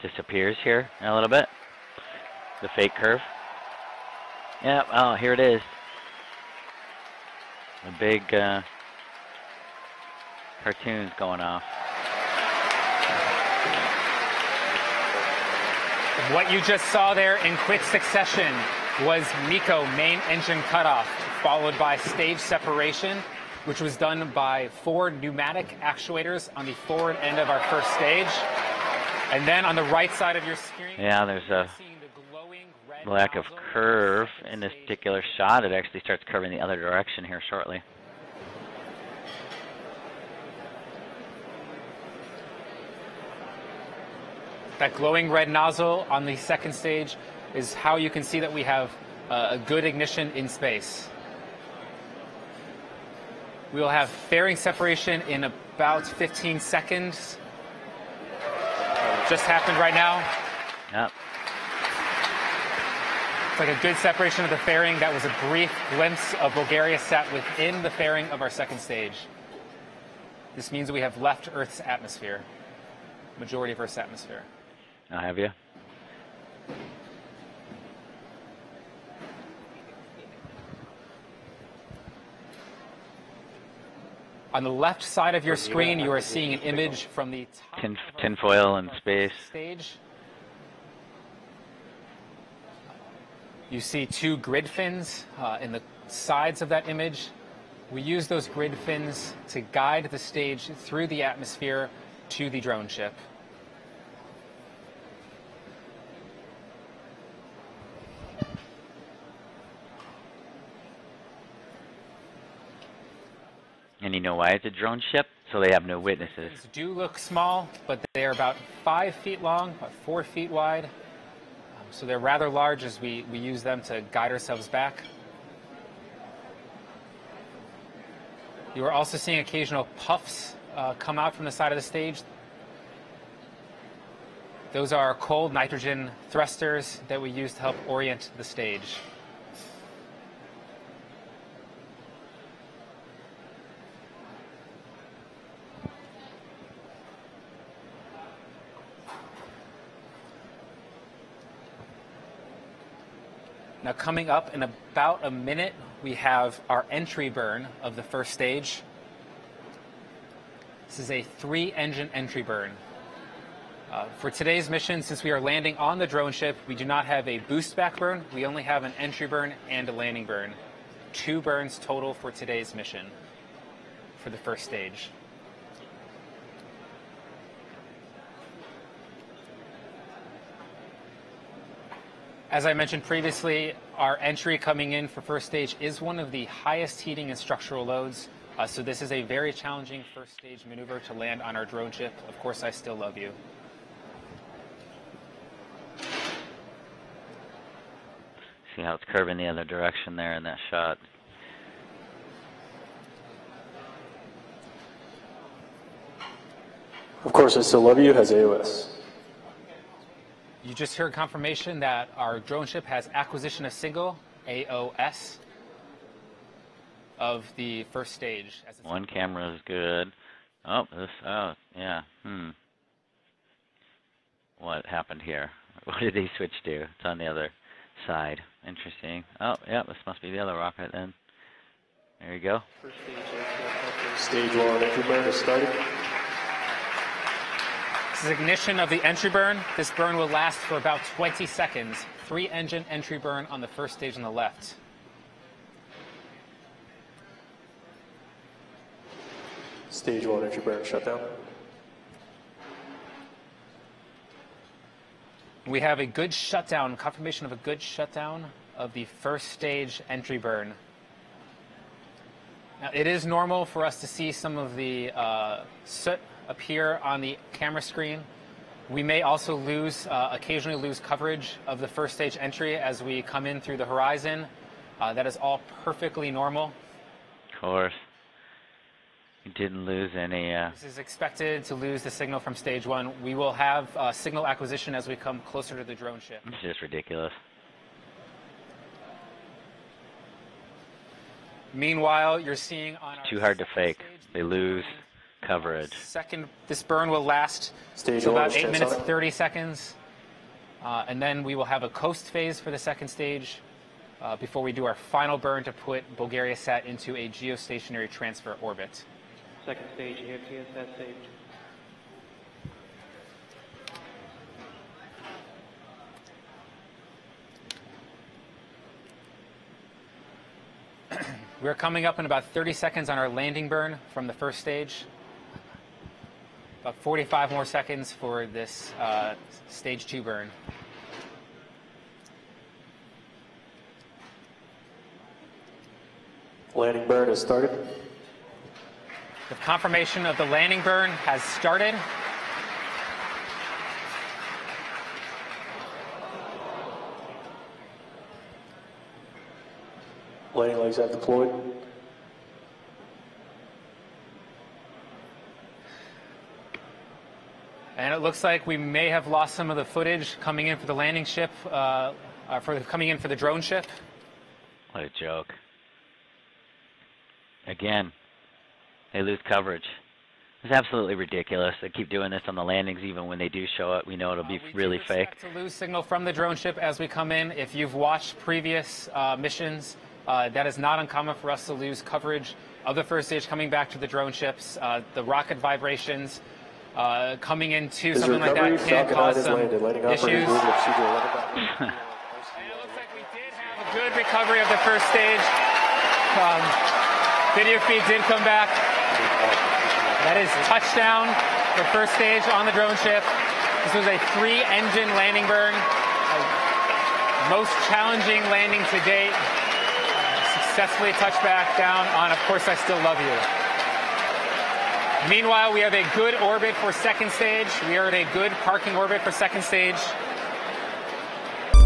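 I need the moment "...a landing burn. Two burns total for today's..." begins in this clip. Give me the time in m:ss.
2:49.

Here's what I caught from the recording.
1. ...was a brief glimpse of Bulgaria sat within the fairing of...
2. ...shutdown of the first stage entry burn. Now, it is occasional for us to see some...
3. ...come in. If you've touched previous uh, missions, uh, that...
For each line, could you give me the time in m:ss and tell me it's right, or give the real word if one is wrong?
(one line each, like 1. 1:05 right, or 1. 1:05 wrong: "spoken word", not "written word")
1. 1:05 right
2. 4:17 wrong: "normal", not "occasional"
3. 6:17 wrong: "watched", not "touched".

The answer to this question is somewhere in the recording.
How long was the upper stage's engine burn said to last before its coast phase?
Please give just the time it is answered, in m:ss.
4:58.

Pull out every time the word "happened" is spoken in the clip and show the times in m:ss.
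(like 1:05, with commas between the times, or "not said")
0:59, 3:44.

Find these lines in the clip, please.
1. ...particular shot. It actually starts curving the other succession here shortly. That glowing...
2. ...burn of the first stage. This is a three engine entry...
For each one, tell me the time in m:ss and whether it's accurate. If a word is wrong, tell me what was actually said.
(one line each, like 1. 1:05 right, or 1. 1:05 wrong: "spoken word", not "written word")
1. 0:34 wrong: "direction", not "succession"
2. 2:37 right.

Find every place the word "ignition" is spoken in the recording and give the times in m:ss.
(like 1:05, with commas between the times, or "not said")
0:49, 3:58.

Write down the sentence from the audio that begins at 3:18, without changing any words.
See how it's curving the other direction there in that shot.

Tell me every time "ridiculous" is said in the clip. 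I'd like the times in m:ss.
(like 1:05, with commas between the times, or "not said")
4:46, 6:11.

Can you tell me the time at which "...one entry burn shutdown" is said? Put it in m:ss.
4:10.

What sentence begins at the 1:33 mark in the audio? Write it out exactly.
You see two grid fins uh, in the sides of that image.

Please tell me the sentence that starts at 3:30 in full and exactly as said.
You just heard confirmation that our drone ship has acquisition of single, AOS, of the first stage.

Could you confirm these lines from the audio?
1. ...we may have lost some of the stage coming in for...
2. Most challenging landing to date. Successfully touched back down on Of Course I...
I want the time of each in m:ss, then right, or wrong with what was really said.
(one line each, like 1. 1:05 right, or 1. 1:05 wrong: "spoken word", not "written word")
1. 5:58 wrong: "footage", not "stage"
2. 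6:47 right.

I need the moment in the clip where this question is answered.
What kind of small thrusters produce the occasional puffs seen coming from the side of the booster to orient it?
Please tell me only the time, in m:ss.
2:15.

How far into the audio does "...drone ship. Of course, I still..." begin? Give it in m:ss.
3:11.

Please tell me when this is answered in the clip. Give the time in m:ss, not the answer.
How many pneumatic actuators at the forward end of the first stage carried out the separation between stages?
0:24.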